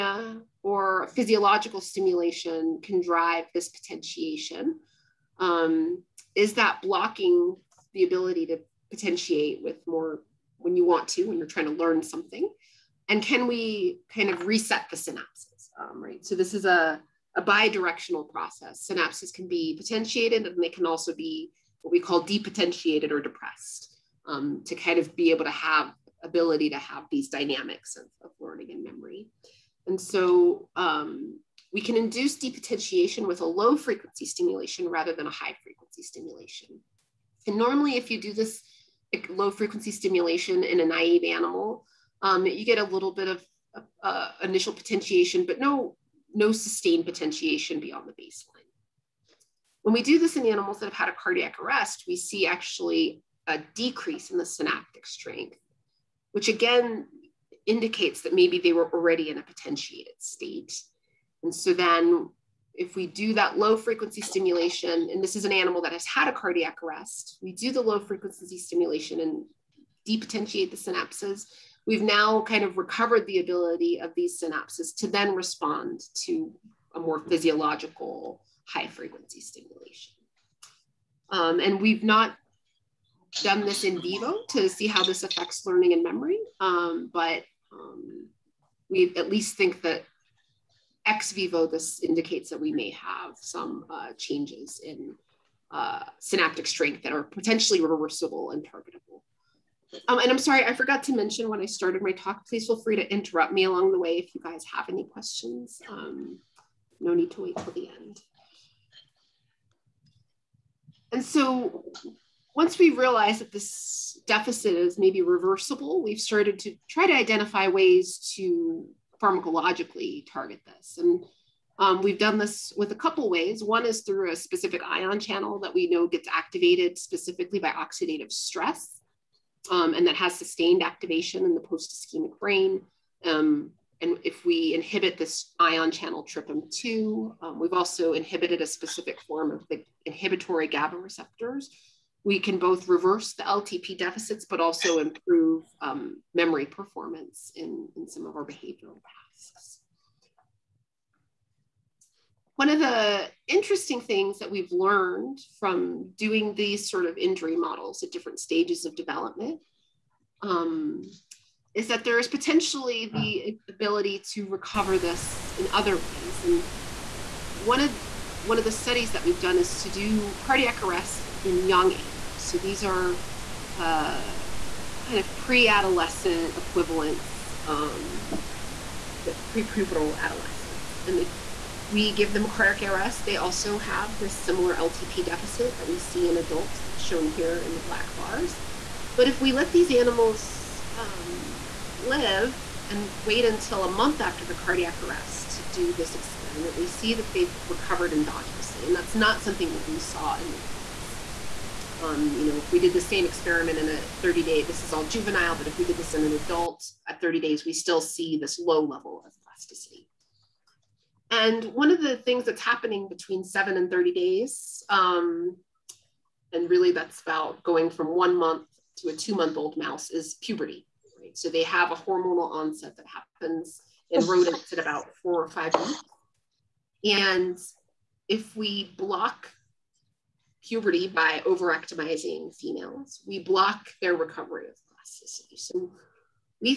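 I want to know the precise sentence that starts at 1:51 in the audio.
And so once we realize that this deficit is maybe reversible, we've started to try to identify ways to pharmacologically target this.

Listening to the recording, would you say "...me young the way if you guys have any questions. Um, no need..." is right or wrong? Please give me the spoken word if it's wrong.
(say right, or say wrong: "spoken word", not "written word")
wrong: "along", not "young".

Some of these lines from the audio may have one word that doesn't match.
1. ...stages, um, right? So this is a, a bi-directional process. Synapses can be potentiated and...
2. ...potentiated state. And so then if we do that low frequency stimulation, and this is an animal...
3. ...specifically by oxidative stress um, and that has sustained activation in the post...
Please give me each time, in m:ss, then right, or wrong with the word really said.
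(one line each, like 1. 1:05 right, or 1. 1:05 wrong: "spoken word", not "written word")
1. 0:14 wrong: "synapses", not "stages"
2. 0:59 right
3. 2:06 right.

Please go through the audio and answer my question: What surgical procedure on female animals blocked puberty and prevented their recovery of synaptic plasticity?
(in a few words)
ovariectomizing.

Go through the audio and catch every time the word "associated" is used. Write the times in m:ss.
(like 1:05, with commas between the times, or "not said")
not said.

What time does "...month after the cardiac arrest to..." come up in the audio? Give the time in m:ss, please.
3:13.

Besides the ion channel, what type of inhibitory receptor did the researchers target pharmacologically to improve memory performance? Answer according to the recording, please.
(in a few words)
GABA receptors.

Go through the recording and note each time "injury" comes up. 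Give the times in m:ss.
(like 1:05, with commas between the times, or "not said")
2:37.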